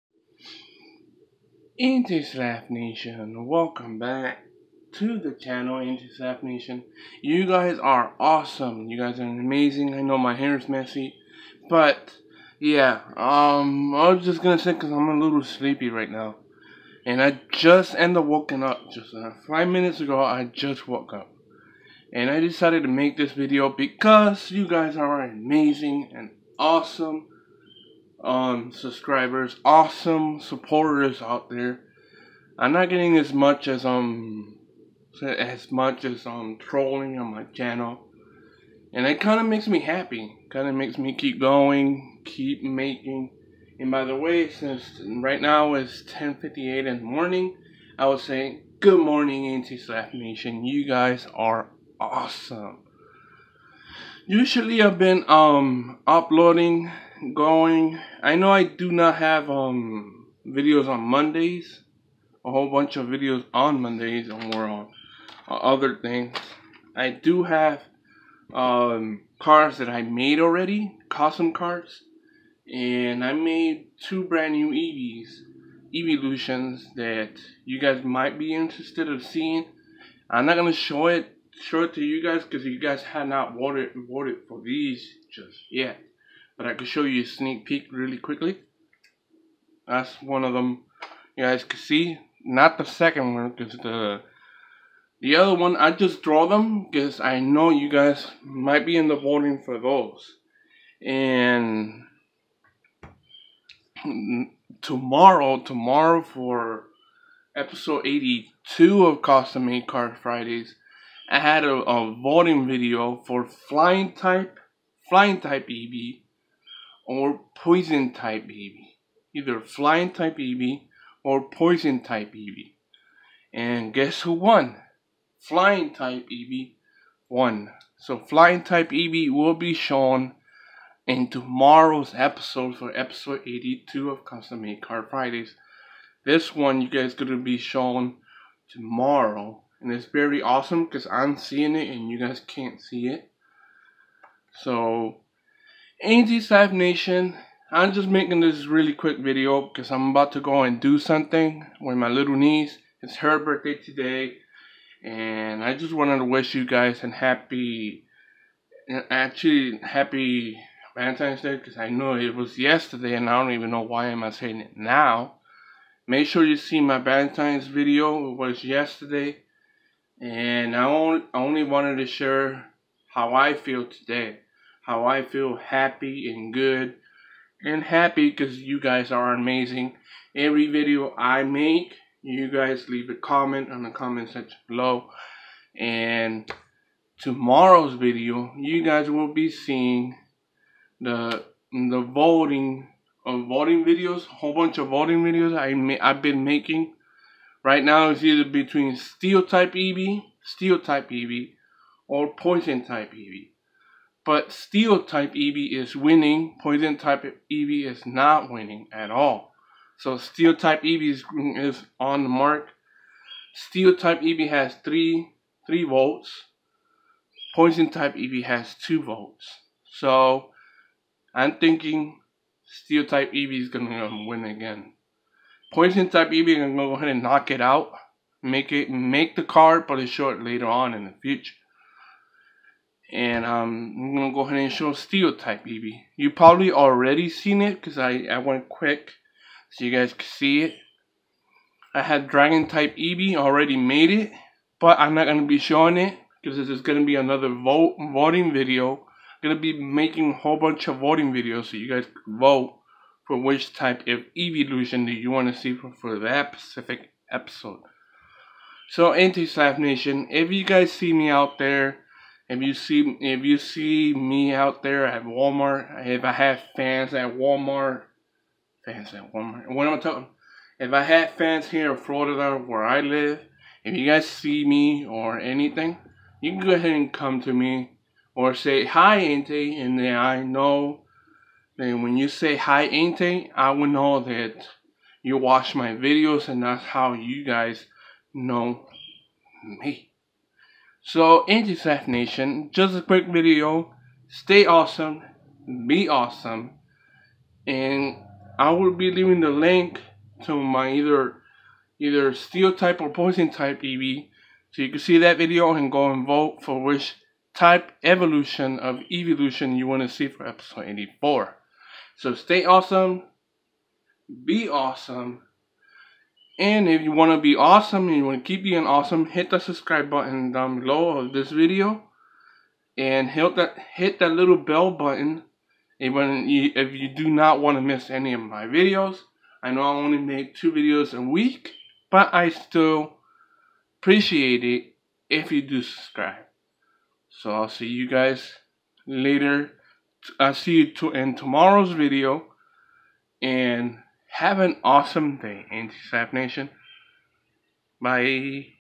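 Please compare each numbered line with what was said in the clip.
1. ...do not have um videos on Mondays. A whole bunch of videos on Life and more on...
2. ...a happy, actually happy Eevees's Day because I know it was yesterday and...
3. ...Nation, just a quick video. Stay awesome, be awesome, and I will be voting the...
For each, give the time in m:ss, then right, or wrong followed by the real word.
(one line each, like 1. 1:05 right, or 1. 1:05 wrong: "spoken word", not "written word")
1. 0:58 wrong: "Mondays", not "Life"
2. 2:37 wrong: "Valentine", not "Eevees"
3. 4:52 wrong: "leaving", not "voting".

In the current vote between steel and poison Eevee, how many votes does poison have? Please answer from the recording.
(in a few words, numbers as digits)
2.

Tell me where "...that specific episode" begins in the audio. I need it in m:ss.
4:16.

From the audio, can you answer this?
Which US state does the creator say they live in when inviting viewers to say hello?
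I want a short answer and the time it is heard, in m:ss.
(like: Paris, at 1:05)
Florida, at 4:31.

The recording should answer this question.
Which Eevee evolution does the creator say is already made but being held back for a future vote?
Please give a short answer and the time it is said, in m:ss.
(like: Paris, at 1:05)
Dragon type, at 4:02.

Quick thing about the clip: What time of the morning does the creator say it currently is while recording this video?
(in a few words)
10:58.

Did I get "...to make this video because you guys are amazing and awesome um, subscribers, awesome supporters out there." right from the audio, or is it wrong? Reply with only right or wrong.
right.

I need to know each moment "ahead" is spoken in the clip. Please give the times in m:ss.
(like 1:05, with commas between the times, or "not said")
3:46, 3:54, 4:36.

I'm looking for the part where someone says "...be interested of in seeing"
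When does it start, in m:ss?
1:18.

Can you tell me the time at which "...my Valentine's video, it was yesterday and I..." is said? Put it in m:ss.
2:46.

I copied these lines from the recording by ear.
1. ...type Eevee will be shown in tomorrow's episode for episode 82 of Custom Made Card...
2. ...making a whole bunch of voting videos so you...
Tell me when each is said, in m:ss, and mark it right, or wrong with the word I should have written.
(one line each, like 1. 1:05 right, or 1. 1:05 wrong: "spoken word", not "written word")
1. 2:08 right
2. 4:09 right.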